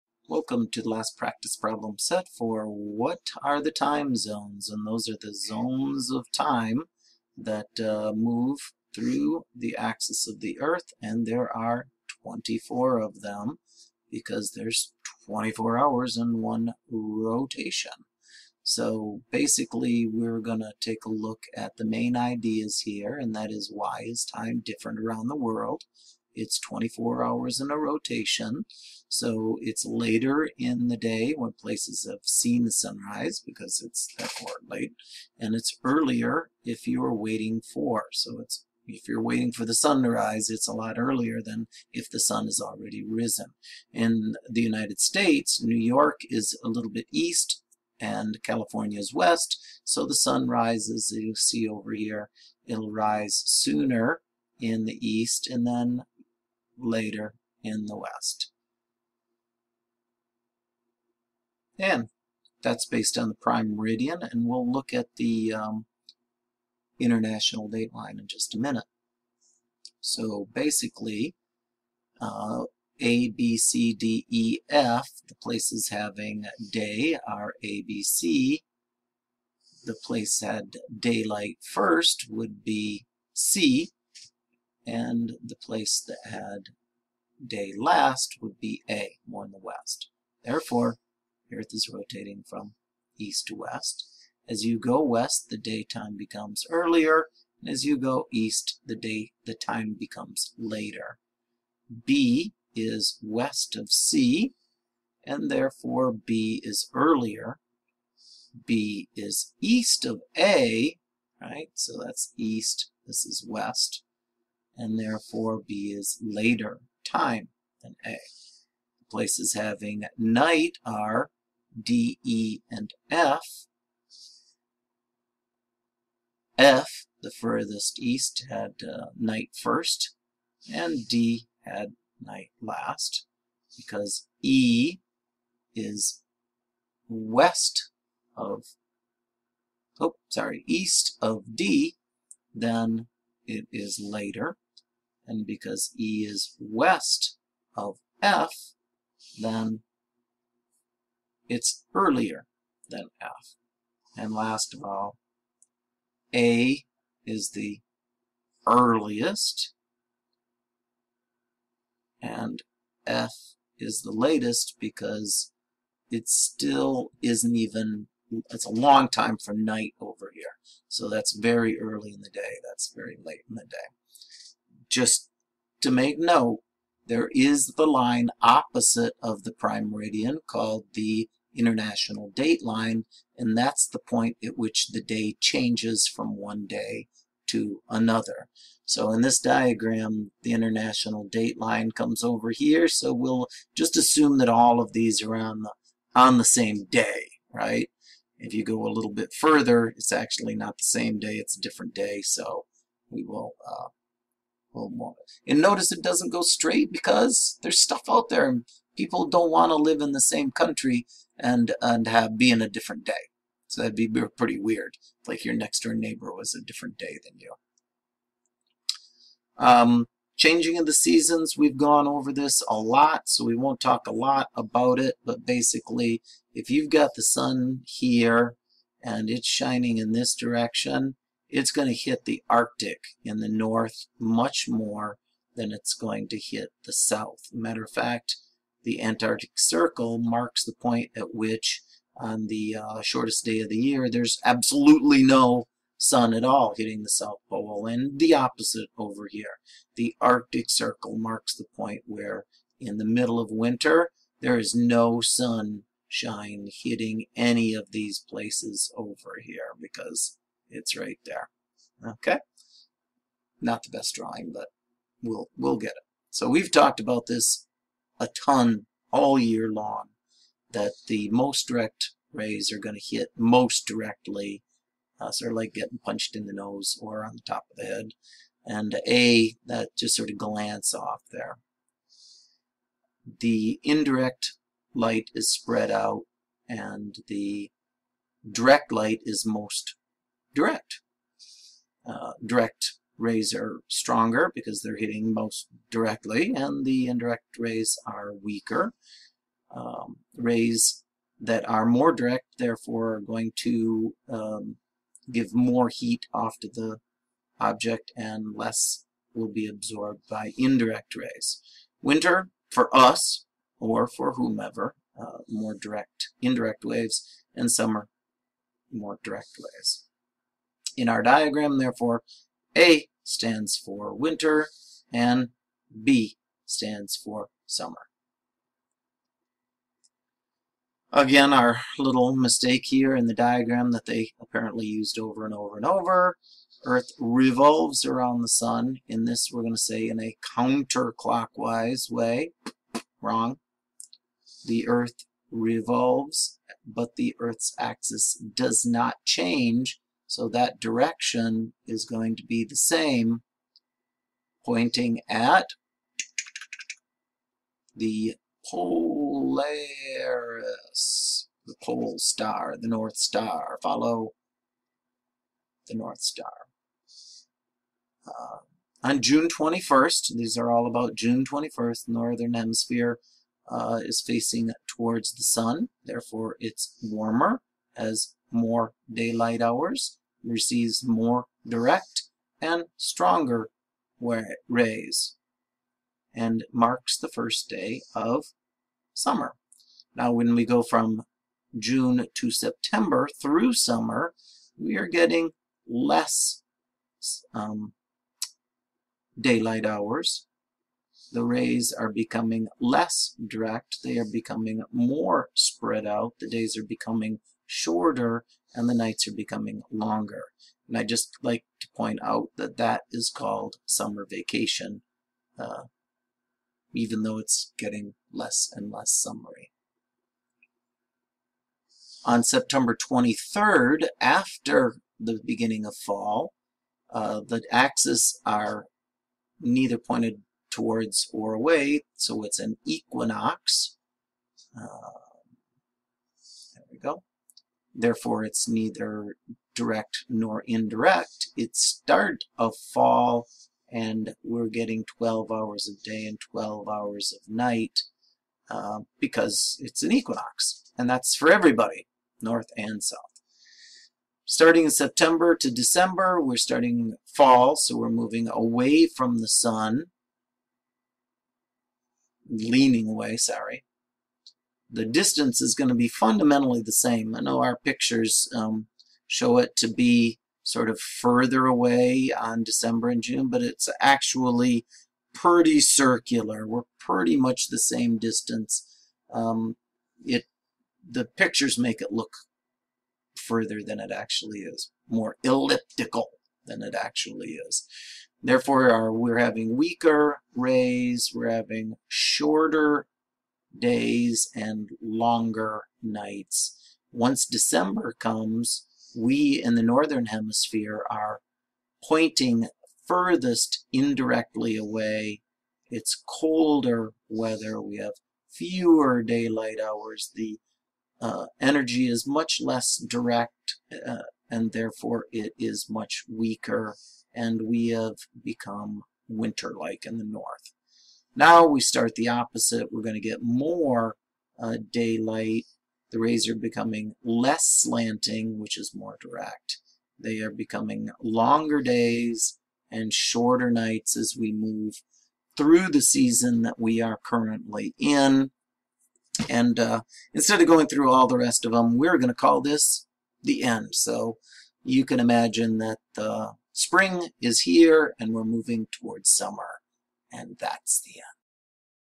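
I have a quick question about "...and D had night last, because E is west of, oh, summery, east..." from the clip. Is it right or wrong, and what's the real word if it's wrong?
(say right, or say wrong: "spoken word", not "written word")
wrong: "sorry", not "summery".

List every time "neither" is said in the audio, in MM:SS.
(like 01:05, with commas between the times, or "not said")
07:09, 07:18.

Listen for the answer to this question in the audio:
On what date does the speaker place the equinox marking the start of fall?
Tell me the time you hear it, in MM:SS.
07:02.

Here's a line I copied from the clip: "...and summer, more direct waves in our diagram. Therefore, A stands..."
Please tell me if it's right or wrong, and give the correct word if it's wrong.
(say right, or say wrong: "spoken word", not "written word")
right.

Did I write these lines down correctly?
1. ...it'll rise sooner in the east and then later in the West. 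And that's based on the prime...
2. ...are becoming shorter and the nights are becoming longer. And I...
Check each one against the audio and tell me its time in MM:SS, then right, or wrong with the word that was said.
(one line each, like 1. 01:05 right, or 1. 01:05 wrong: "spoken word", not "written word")
1. 00:52 right
2. 06:46 right.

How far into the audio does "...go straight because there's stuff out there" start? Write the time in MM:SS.
03:26.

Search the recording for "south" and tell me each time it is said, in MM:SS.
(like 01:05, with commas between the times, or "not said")
03:56, 04:07, 07:33.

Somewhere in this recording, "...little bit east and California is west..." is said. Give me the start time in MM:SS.
00:46.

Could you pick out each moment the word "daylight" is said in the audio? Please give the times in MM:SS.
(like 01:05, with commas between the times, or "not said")
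01:20, 06:19, 06:39, 08:29, 08:44.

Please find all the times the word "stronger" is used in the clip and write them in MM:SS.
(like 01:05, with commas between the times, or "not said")
04:53, 06:22.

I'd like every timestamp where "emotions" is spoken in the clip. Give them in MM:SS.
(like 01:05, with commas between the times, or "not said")
not said.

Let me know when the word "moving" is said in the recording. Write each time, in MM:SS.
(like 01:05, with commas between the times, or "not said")
07:38, 09:08.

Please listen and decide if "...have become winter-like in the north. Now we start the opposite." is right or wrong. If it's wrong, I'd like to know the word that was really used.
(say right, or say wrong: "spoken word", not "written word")
right.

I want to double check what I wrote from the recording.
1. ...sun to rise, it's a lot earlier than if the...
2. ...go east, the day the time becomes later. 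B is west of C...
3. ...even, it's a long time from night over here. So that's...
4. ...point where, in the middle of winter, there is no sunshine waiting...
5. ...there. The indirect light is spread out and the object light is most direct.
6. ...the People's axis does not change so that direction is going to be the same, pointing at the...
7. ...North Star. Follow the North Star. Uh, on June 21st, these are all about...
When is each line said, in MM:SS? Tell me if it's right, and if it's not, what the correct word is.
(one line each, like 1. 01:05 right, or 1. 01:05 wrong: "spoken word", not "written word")
1. 00:39 right
2. 01:37 right
3. 02:47 right
4. 04:11 wrong: "hitting", not "waiting"
5. 04:41 wrong: "direct", not "object"
6. 05:47 wrong: "Earth", not "People"
7. 06:02 right.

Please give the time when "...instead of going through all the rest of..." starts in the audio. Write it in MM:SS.
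09:00.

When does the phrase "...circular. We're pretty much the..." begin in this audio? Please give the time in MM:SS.
07:55.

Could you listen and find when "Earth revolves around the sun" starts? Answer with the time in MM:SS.
05:36.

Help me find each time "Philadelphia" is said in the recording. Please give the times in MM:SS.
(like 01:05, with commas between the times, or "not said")
not said.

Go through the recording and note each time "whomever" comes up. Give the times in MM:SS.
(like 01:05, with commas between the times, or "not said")
05:14.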